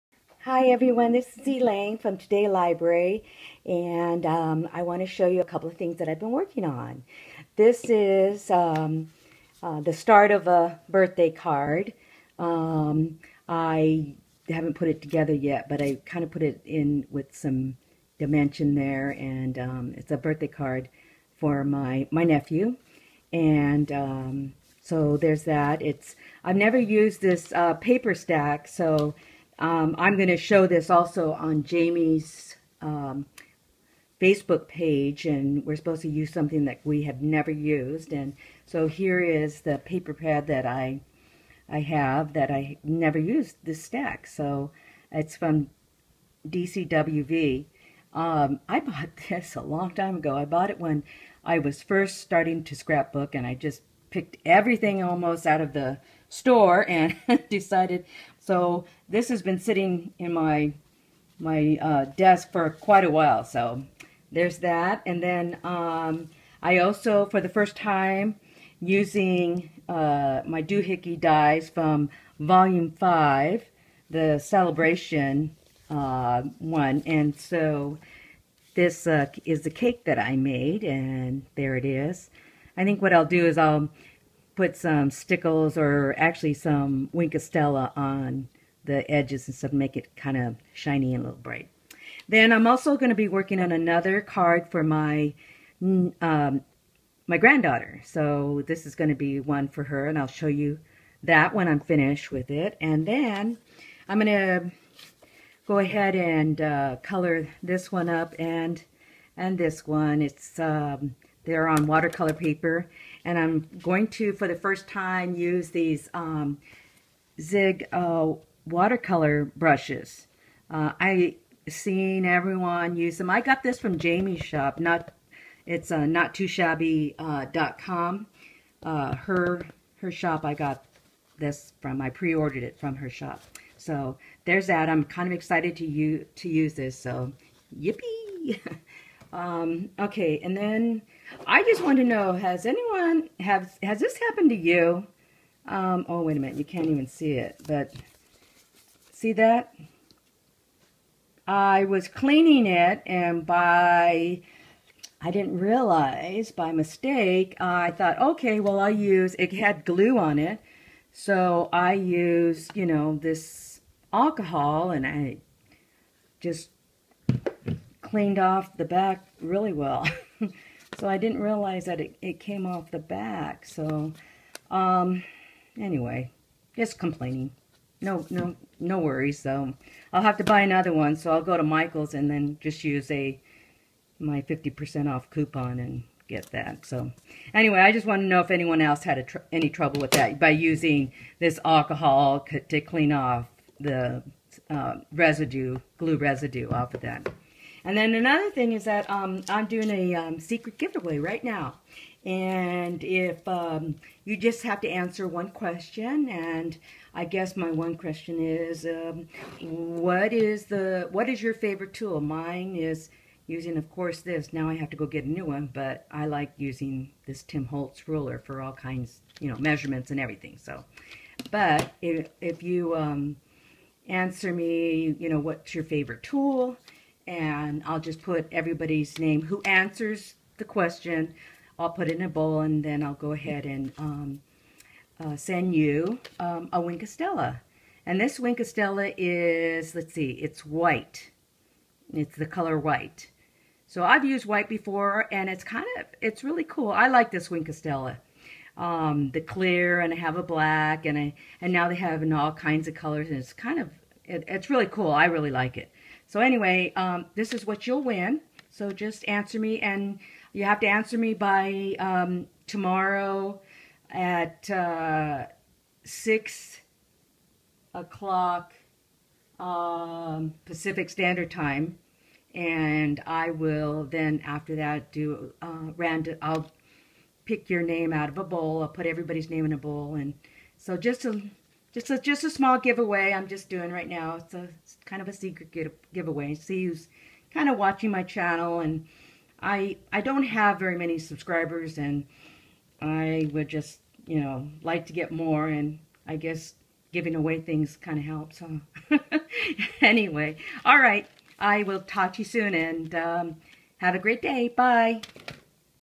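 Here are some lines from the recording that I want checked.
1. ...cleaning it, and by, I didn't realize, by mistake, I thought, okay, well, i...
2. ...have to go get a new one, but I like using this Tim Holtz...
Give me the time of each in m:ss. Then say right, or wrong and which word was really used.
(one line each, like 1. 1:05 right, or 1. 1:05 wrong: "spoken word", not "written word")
1. 2:32 right
2. 3:34 right.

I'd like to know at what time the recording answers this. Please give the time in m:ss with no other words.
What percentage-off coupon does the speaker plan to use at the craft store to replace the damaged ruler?
3:04.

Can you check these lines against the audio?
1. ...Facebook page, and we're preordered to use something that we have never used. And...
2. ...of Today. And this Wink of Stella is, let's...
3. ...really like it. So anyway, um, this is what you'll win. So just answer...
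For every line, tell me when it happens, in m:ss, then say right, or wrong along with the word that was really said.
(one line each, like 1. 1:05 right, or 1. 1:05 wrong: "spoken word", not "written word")
1. 0:34 wrong: "supposed", not "preordered"
2. 3:57 wrong: "Stella", not "Today"
3. 4:15 right.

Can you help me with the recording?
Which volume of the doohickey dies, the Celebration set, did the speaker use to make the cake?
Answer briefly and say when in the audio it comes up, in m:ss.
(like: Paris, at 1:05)
Volume 5, at 1:12.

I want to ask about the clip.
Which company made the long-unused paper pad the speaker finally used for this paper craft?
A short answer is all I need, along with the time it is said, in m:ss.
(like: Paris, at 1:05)
DCWV, at 0:46.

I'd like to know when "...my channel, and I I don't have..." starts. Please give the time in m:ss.
4:48.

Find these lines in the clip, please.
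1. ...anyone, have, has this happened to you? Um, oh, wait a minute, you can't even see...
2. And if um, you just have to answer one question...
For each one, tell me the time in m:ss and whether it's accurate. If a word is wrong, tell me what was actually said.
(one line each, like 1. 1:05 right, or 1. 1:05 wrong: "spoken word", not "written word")
1. 2:22 right
2. 3:22 right.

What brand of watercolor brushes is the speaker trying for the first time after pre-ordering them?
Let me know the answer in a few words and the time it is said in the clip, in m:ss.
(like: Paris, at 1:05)
Zig, at 1:57.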